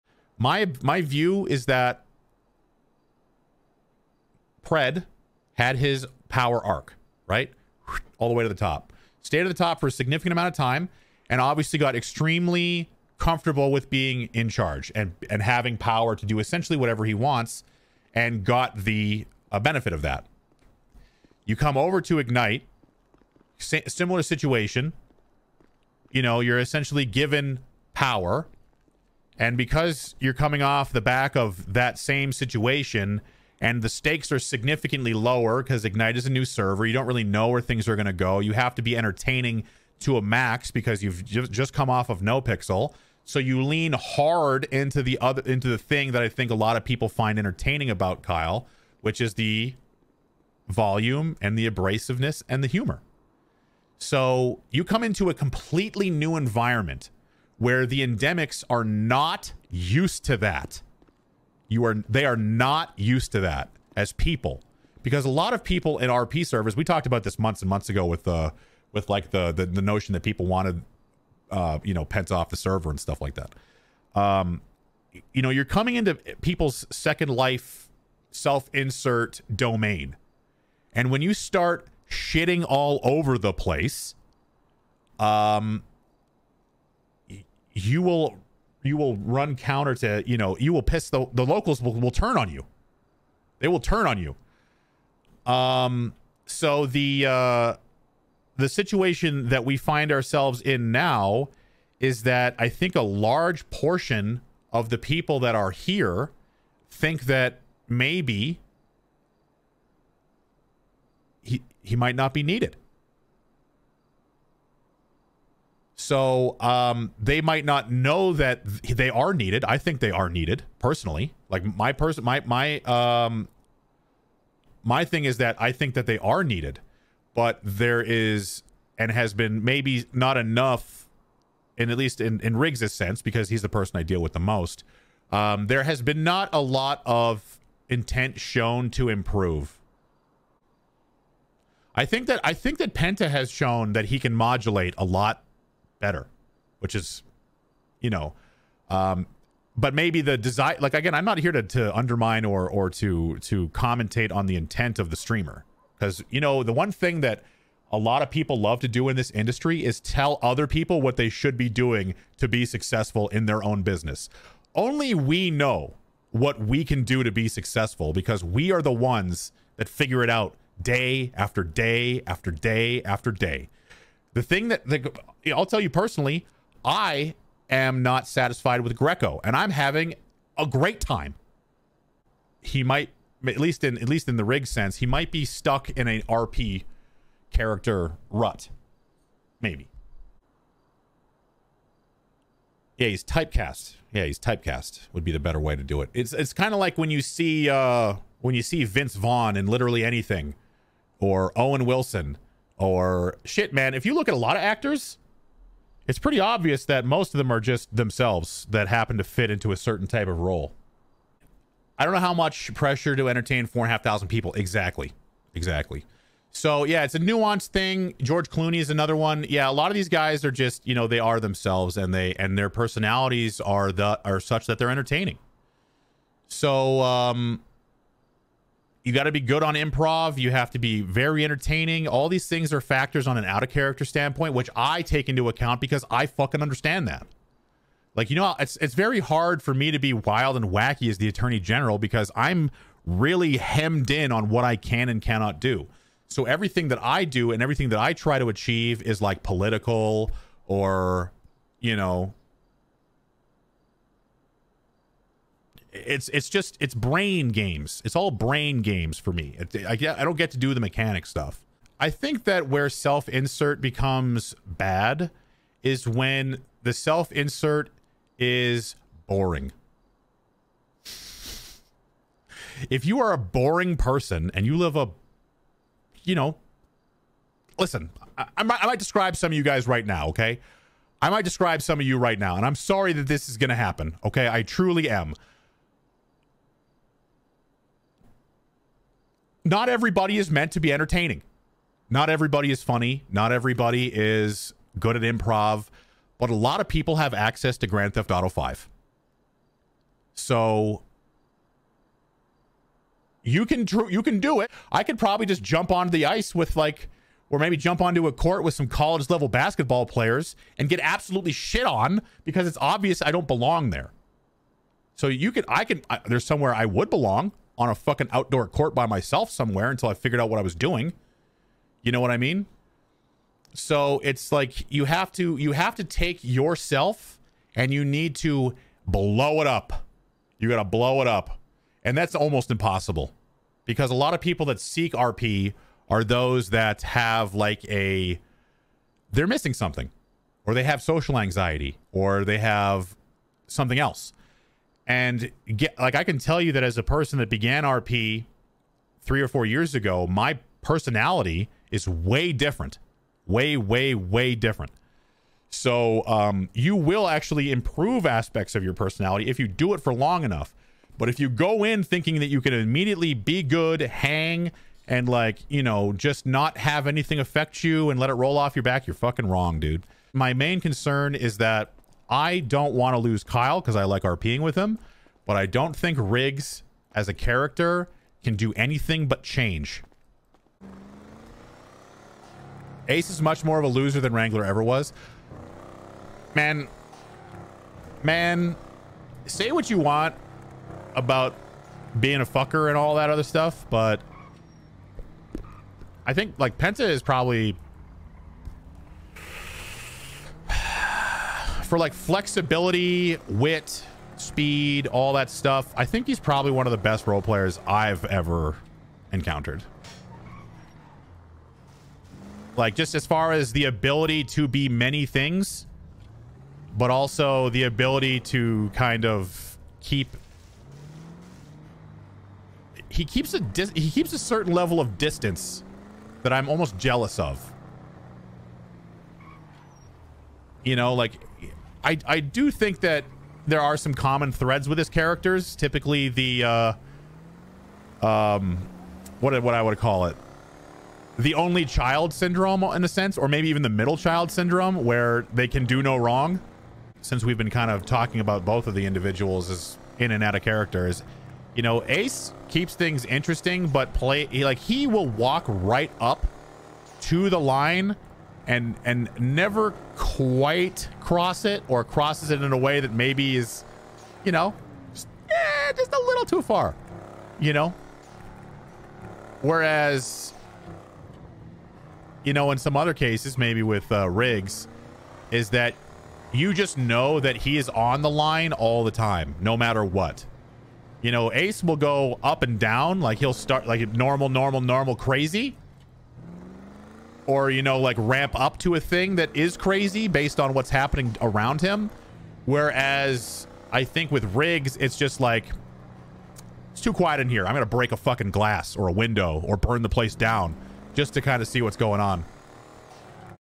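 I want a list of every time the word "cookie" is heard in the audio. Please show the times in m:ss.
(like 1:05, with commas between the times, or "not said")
not said.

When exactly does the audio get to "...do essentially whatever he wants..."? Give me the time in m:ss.
0:16.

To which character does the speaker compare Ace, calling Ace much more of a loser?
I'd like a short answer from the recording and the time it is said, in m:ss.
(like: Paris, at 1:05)
Wrangler, at 6:24.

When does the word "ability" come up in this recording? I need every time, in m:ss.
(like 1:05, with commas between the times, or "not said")
6:53, 6:57.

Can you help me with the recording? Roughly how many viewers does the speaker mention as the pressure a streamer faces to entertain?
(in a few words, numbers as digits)
4,500.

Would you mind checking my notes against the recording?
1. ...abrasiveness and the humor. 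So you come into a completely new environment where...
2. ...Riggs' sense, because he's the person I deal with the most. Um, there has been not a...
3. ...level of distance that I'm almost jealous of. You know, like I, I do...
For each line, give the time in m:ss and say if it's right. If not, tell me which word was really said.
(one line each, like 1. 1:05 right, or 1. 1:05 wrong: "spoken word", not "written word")
1. 0:51 right
2. 2:12 right
3. 7:04 right.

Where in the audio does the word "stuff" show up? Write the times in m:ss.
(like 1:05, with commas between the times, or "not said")
1:12, 4:21, 6:33, 6:45.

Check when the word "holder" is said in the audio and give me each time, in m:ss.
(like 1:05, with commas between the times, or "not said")
not said.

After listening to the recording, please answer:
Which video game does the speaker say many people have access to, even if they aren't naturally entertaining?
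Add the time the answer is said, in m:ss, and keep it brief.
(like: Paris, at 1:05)
Grand Theft Auto 5, at 4:57.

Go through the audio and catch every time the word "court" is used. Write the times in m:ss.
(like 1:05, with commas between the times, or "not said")
5:08, 5:18.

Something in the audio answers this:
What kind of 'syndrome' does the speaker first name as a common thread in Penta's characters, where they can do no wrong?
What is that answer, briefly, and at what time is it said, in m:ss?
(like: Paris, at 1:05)
Only child syndrome, at 7:21.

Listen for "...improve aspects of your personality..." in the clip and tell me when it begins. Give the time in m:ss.
5:57.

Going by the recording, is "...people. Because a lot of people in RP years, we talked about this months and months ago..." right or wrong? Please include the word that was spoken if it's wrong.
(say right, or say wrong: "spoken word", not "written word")
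wrong: "servers", not "years".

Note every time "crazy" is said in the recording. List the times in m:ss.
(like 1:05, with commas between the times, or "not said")
8:05, 8:09.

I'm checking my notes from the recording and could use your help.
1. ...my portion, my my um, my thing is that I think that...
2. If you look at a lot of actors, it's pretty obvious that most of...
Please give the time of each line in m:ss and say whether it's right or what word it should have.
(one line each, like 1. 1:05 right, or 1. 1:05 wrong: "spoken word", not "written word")
1. 2:01 wrong: "person", not "portion"
2. 3:23 right.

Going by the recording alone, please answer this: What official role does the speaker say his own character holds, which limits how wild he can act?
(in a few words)
Attorney general.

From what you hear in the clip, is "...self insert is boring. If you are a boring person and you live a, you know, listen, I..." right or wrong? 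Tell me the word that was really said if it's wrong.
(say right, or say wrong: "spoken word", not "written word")
right.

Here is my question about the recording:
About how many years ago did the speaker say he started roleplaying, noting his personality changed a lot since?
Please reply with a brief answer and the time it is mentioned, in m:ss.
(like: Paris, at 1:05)
3 or 4 years, at 5:49.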